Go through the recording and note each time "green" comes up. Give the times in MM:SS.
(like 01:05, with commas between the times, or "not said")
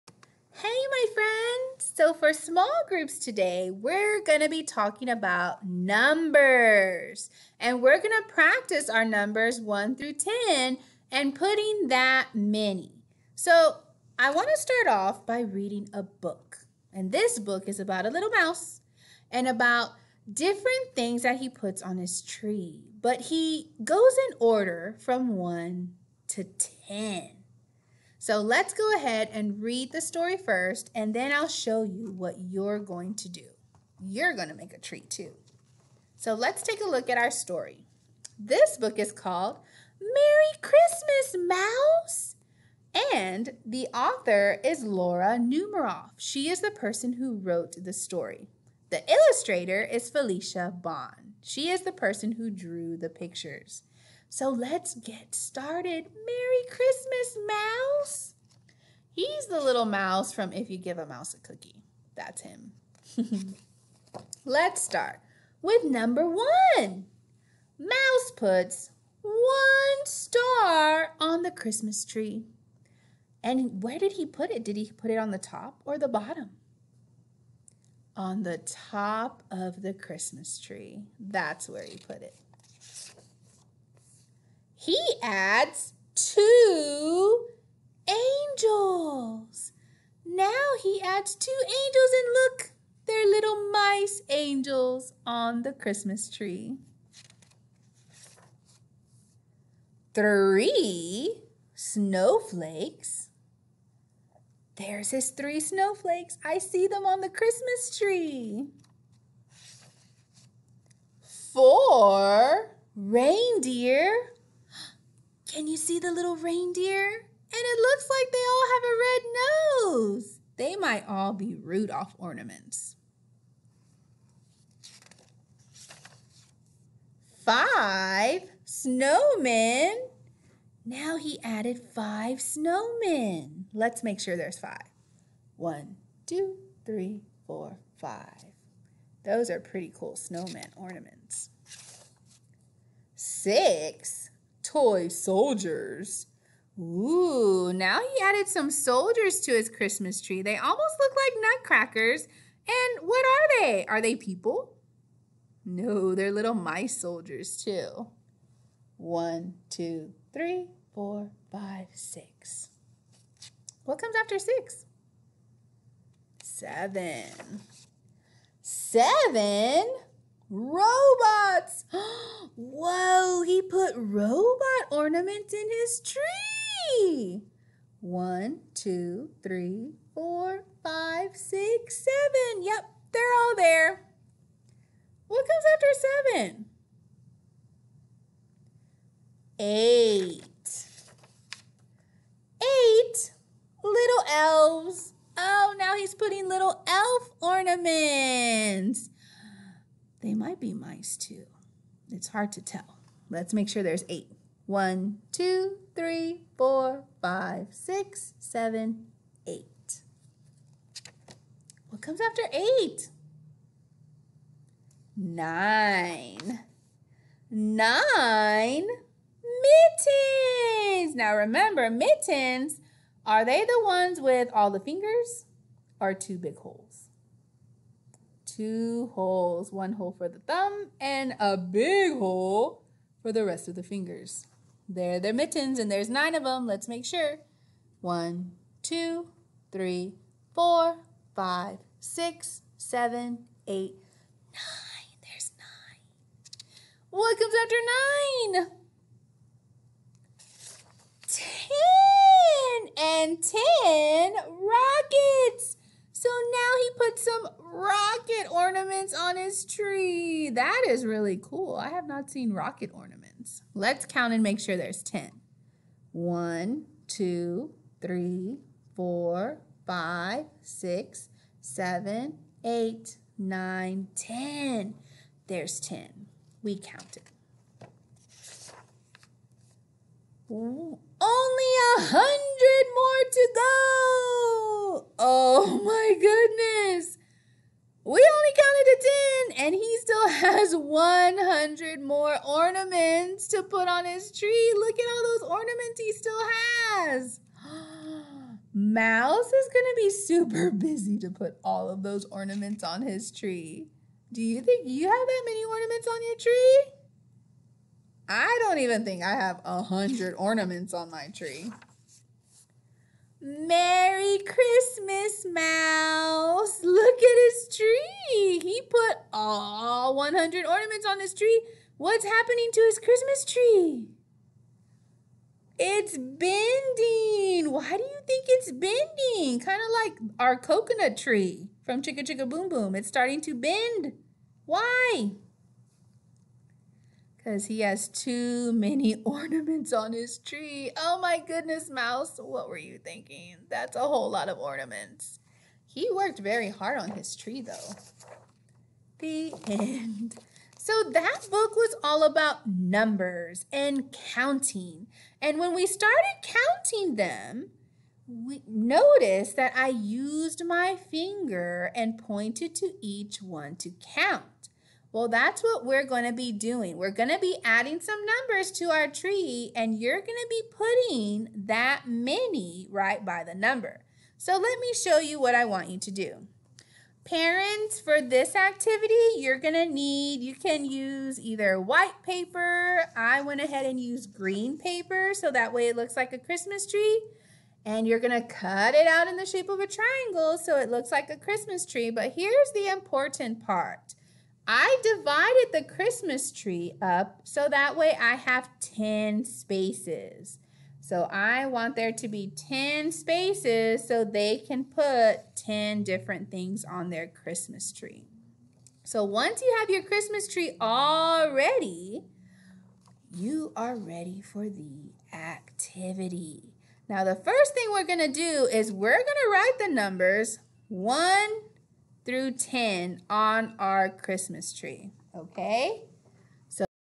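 06:24.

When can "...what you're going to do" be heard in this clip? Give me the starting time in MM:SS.
00:32.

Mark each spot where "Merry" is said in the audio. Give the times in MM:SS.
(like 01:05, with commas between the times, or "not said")
00:39, 00:56, 05:13.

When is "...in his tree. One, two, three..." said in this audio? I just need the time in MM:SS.
02:55.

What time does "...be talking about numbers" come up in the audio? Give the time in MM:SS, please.
00:04.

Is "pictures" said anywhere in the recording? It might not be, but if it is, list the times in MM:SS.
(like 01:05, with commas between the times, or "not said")
00:53.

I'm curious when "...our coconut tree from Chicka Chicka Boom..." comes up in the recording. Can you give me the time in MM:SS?
05:30.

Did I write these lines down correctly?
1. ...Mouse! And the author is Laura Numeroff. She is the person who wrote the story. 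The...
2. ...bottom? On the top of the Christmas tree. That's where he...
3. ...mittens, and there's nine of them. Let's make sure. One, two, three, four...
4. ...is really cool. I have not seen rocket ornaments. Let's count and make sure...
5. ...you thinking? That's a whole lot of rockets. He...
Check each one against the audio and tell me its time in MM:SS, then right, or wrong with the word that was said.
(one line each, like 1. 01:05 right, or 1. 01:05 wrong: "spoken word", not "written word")
1. 00:41 right
2. 01:16 right
3. 03:55 right
4. 04:20 right
5. 05:42 wrong: "ornaments", not "rockets".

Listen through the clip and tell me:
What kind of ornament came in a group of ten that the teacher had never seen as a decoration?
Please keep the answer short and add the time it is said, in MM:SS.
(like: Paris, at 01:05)
Rockets, at 04:14.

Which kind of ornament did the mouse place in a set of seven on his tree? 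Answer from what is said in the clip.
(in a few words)
Robots.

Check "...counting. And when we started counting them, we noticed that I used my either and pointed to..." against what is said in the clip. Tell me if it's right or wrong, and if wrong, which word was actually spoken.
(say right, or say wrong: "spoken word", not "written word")
wrong: "finger", not "either".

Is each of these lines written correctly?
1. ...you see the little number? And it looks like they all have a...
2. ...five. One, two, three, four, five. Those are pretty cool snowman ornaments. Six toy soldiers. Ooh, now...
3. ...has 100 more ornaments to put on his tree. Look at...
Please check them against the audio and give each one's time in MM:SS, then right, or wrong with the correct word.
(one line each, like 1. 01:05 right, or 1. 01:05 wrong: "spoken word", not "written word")
1. 01:55 wrong: "reindeer", not "number"
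2. 02:14 right
3. 04:50 right.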